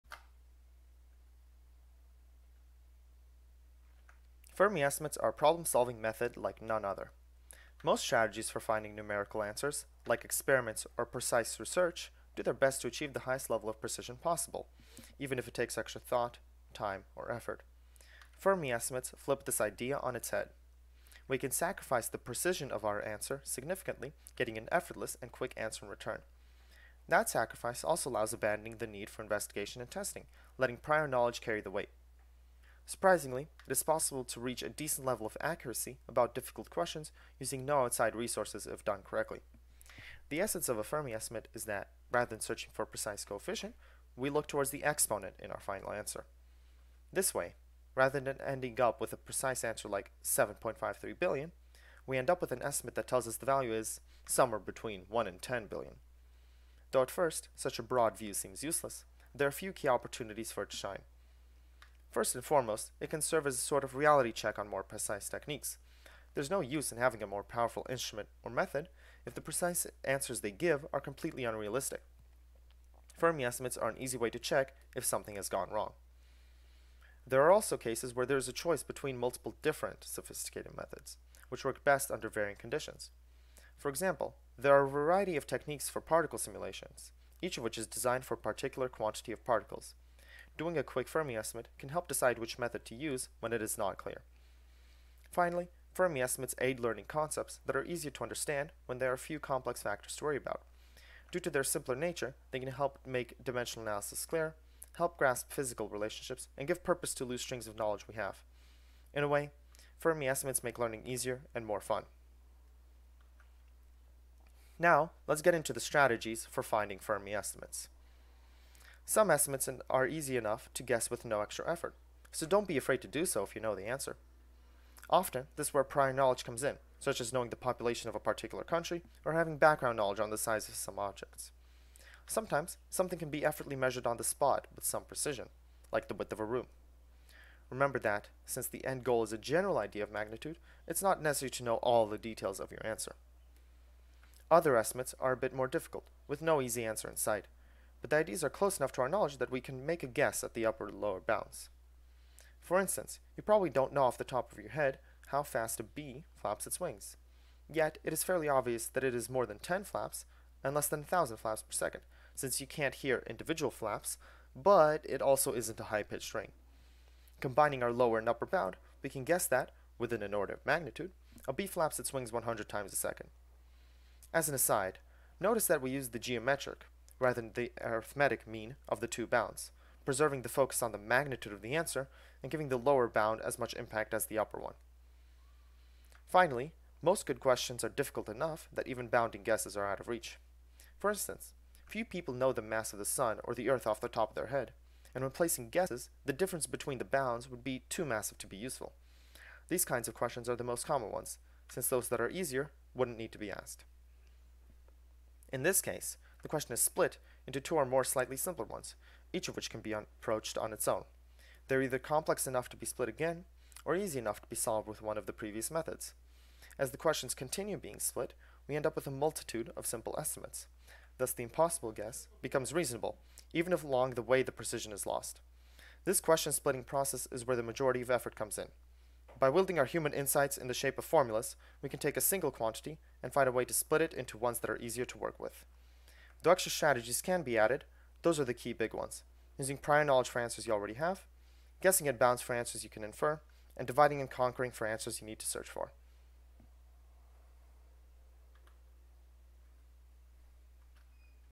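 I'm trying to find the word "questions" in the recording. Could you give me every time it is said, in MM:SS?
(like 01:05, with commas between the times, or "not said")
00:36, 03:07, 03:20, 03:26, 03:36, 03:46.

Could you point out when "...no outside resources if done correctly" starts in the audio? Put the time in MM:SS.
00:37.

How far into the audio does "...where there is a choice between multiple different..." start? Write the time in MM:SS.
01:18.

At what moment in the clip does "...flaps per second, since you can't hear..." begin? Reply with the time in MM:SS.
02:41.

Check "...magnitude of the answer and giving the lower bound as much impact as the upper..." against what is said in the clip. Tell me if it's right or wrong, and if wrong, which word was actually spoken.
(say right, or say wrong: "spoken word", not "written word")
right.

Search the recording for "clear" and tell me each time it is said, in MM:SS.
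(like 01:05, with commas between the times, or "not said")
01:33, 01:44.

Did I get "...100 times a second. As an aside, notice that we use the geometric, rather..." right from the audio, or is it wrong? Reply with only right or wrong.
right.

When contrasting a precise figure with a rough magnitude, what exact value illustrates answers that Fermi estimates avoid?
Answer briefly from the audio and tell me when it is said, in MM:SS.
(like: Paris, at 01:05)
7.53 billion, at 00:50.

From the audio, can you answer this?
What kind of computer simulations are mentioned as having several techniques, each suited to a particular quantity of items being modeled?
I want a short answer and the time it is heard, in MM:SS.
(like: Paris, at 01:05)
particle simulations, at 01:26.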